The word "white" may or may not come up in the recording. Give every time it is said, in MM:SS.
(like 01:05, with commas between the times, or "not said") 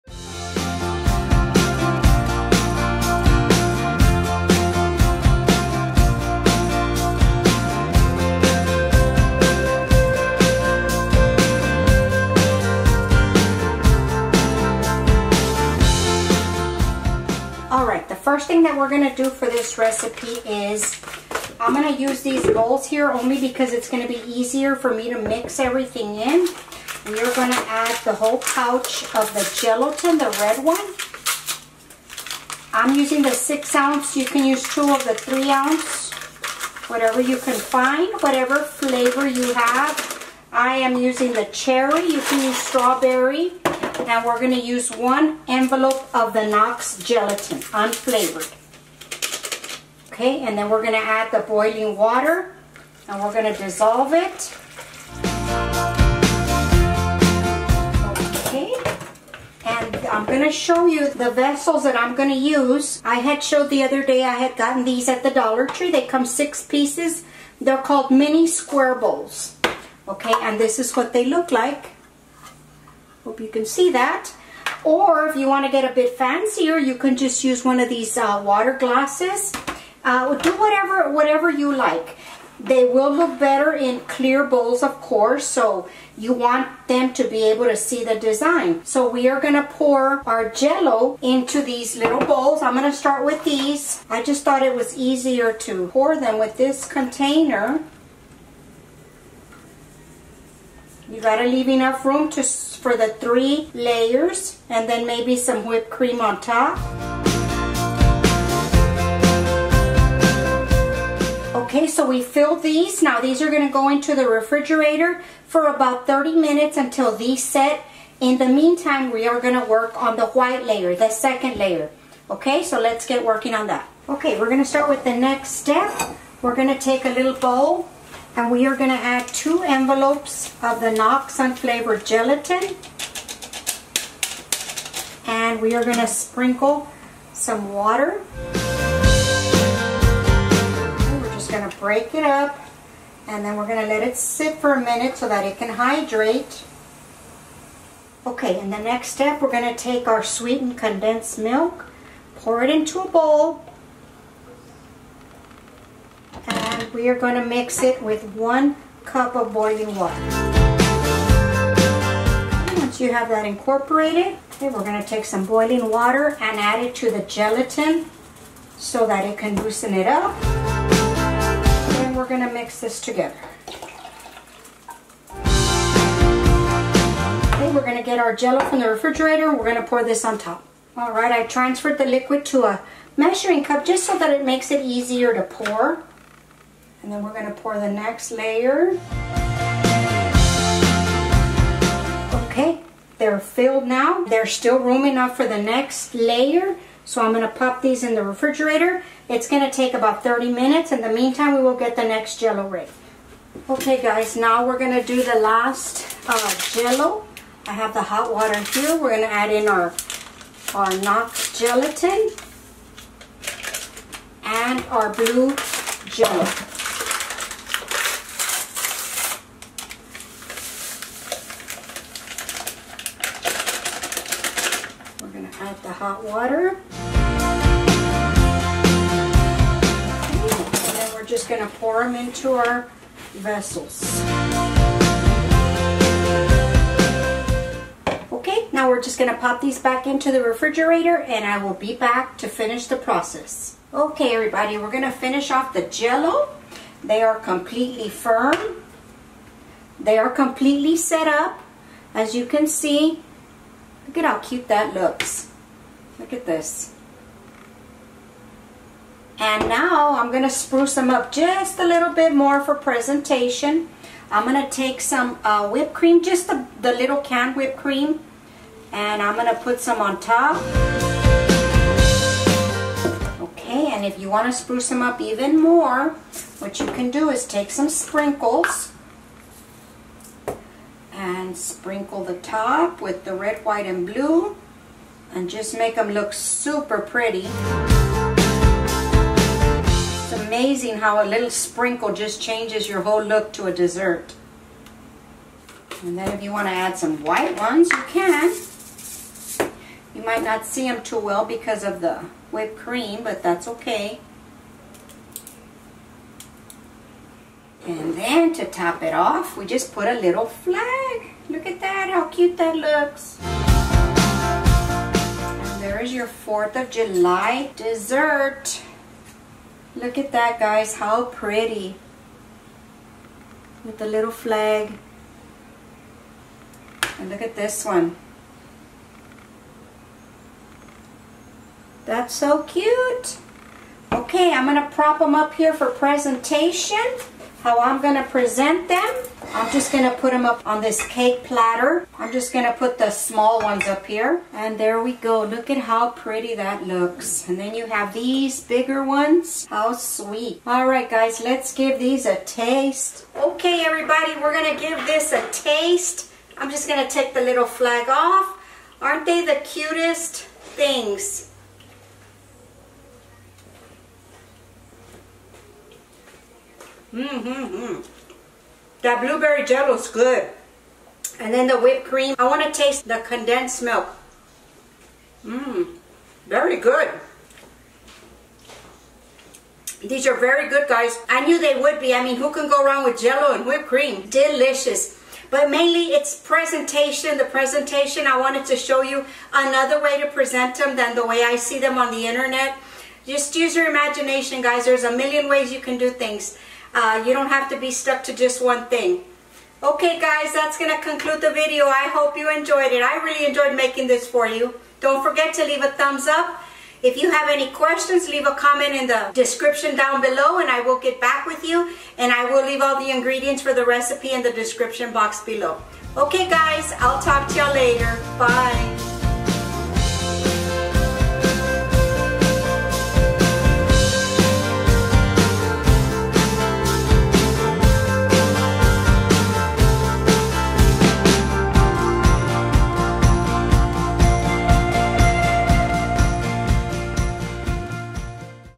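02:00, 04:43, 04:57.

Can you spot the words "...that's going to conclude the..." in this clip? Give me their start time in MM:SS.
06:40.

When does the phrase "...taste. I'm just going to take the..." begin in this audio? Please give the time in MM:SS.
05:55.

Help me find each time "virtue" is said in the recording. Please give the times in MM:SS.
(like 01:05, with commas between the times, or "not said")
not said.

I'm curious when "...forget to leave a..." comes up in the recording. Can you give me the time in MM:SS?
06:45.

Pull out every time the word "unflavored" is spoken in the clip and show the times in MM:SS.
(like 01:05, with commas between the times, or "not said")
00:47, 02:11.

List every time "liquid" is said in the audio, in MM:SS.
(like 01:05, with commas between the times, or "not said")
03:02.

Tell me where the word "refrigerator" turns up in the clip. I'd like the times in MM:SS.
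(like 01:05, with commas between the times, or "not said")
01:54, 02:58, 03:18, 04:00.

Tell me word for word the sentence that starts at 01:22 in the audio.
They will look better in clear bowls, of course, so you want them to be able to see the design.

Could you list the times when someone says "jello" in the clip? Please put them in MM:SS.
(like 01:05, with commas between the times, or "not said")
01:30, 02:58, 03:22, 03:26, 03:36, 04:05, 06:09, 06:23.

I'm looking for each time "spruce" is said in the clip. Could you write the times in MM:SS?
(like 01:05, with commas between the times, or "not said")
04:20, 04:34.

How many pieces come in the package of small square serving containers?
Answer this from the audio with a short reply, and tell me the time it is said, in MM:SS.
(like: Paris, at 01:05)
6, at 01:06.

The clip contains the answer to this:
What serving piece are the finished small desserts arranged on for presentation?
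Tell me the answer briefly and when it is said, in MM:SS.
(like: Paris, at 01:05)
Cake platter, at 05:41.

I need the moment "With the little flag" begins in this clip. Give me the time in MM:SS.
05:23.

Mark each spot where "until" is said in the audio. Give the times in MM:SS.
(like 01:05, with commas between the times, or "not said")
01:56.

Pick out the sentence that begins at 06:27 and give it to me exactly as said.
The presentation, I wanted to show you another way to present them than the way I see them on the internet.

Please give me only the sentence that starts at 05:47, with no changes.
And then you have these bigger ones.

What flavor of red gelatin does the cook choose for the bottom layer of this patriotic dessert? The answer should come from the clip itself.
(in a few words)
Cherry.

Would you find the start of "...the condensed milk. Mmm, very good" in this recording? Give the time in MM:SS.
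06:13.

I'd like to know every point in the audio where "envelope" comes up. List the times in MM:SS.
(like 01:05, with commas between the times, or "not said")
00:45, 02:09.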